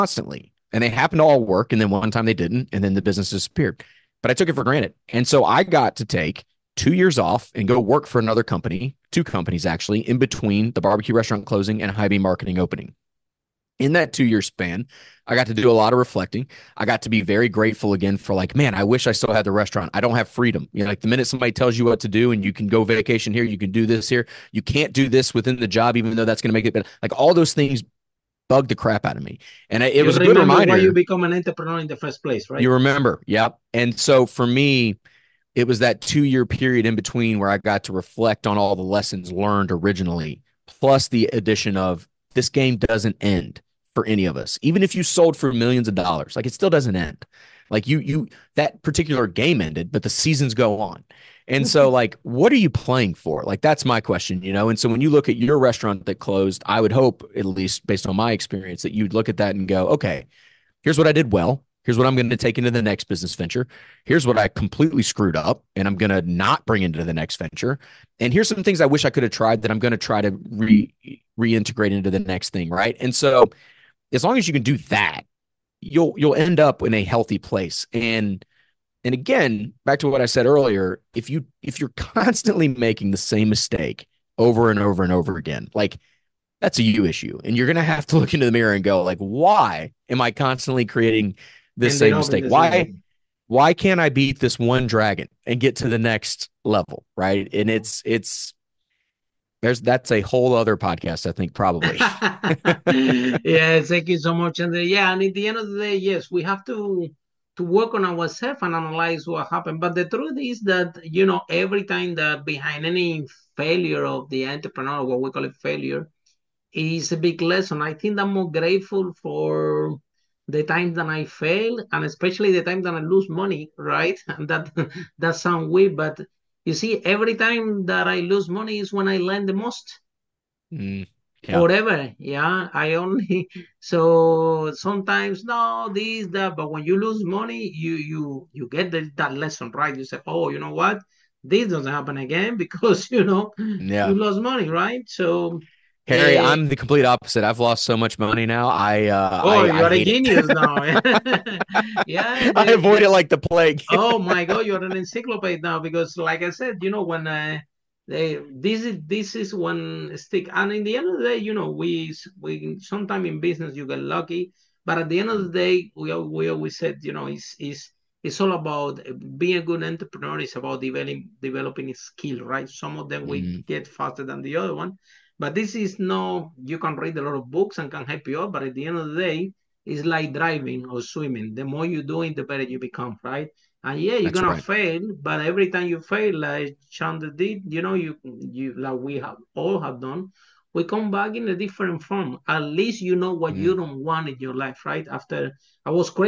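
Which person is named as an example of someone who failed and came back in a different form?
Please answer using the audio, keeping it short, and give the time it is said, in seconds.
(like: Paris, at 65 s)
Chandra, at 186 s.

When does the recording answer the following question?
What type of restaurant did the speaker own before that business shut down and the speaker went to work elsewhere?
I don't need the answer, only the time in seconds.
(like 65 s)
10 s.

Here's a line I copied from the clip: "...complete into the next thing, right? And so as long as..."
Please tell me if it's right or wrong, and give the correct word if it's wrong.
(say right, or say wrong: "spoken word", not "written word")
wrong: "reintegrate", not "complete".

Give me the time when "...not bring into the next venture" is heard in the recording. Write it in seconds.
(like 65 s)
66 s.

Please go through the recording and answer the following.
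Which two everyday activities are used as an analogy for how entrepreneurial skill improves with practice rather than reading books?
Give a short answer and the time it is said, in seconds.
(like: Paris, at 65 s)
Driving or swimming, at 180 s.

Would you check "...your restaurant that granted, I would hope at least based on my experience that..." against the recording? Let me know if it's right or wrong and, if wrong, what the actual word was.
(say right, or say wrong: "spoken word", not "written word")
wrong: "closed", not "granted".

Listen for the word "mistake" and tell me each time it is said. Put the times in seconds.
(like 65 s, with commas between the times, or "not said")
83 s, 92 s.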